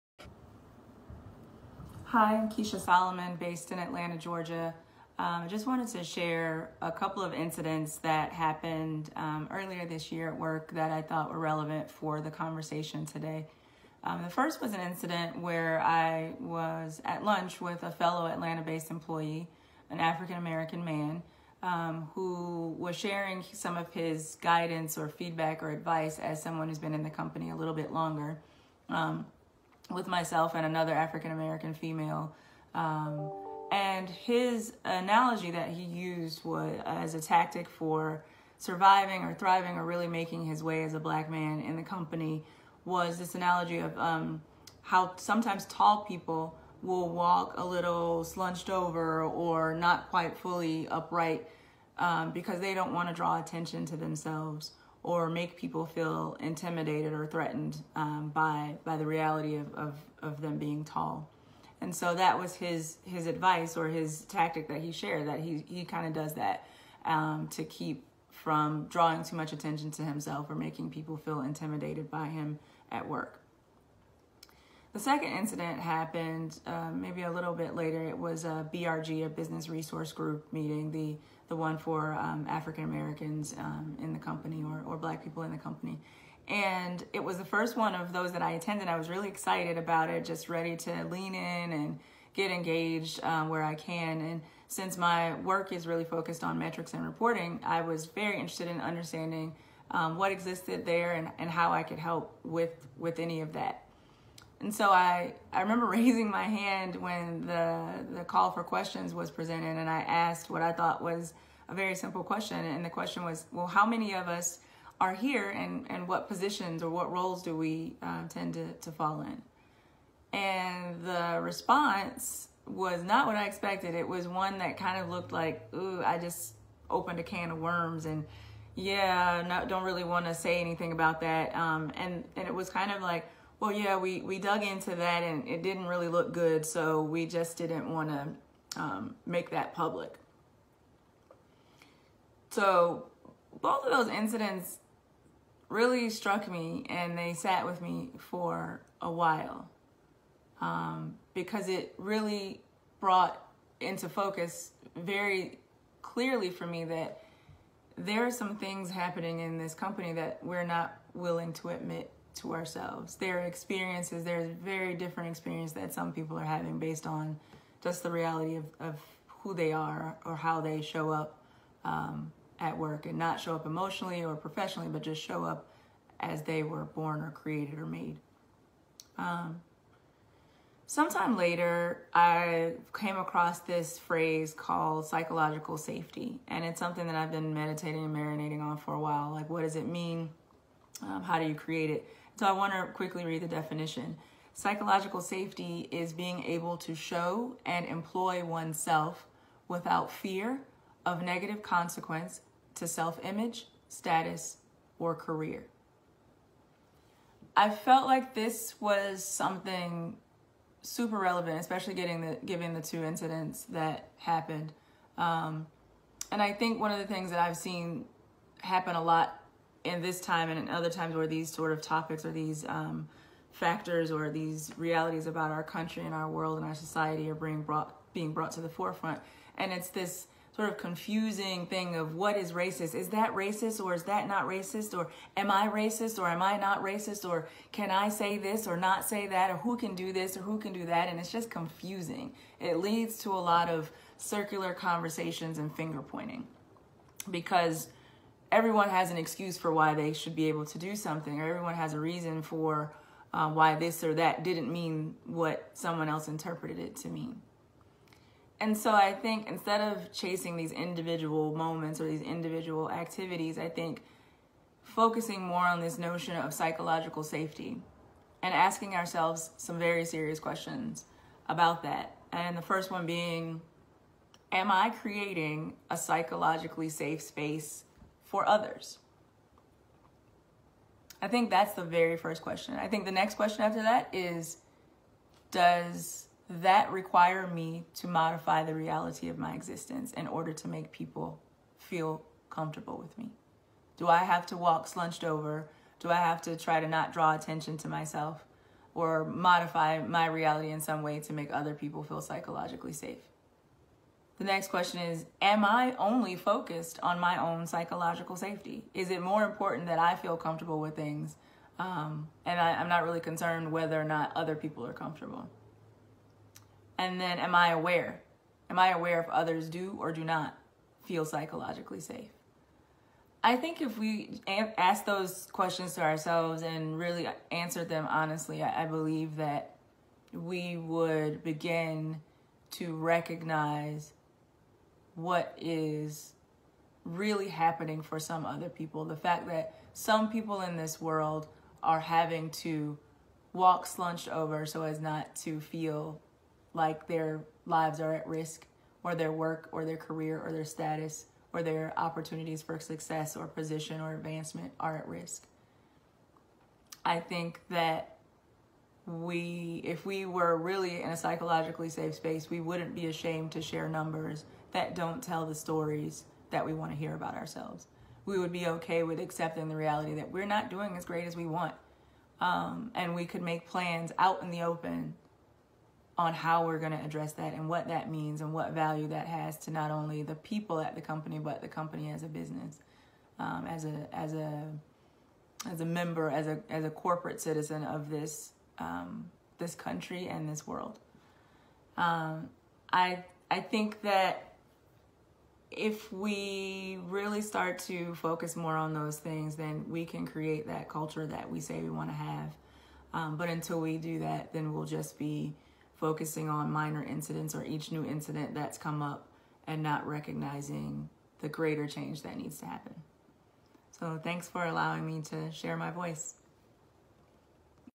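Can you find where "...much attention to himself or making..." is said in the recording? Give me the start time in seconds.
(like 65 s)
69 s.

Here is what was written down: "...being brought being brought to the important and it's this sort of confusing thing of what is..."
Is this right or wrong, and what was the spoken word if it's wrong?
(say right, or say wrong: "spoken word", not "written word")
wrong: "forefront", not "important".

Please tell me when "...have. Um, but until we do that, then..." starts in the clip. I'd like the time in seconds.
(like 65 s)
402 s.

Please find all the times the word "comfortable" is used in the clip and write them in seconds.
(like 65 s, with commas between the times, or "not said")
292 s, 310 s, 314 s.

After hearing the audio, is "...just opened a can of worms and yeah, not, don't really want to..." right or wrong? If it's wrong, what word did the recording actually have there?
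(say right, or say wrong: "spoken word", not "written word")
right.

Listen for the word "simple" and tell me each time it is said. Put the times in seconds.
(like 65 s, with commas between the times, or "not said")
111 s.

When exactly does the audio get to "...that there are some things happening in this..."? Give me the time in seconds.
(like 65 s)
156 s.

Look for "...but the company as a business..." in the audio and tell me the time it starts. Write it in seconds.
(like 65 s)
381 s.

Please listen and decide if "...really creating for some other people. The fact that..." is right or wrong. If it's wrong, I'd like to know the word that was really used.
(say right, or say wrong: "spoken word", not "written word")
wrong: "happening", not "creating".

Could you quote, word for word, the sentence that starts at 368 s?
We would be okay with accepting the reality that we're not doing as great as we want.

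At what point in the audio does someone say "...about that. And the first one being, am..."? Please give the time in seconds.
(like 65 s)
271 s.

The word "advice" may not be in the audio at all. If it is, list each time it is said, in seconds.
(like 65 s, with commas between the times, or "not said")
25 s, 63 s.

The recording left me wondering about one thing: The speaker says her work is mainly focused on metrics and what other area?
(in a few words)
Reporting.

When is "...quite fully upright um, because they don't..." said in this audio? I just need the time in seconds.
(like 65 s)
50 s.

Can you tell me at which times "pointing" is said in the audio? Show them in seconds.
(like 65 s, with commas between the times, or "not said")
246 s.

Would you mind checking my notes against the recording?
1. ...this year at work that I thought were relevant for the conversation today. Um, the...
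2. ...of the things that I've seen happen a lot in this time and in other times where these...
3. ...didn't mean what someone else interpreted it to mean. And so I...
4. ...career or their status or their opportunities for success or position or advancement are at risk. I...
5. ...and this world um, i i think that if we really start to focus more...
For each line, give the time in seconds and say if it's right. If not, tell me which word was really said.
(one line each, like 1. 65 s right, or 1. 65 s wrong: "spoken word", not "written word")
1. 9 s right
2. 216 s right
3. 254 s right
4. 349 s right
5. 390 s right.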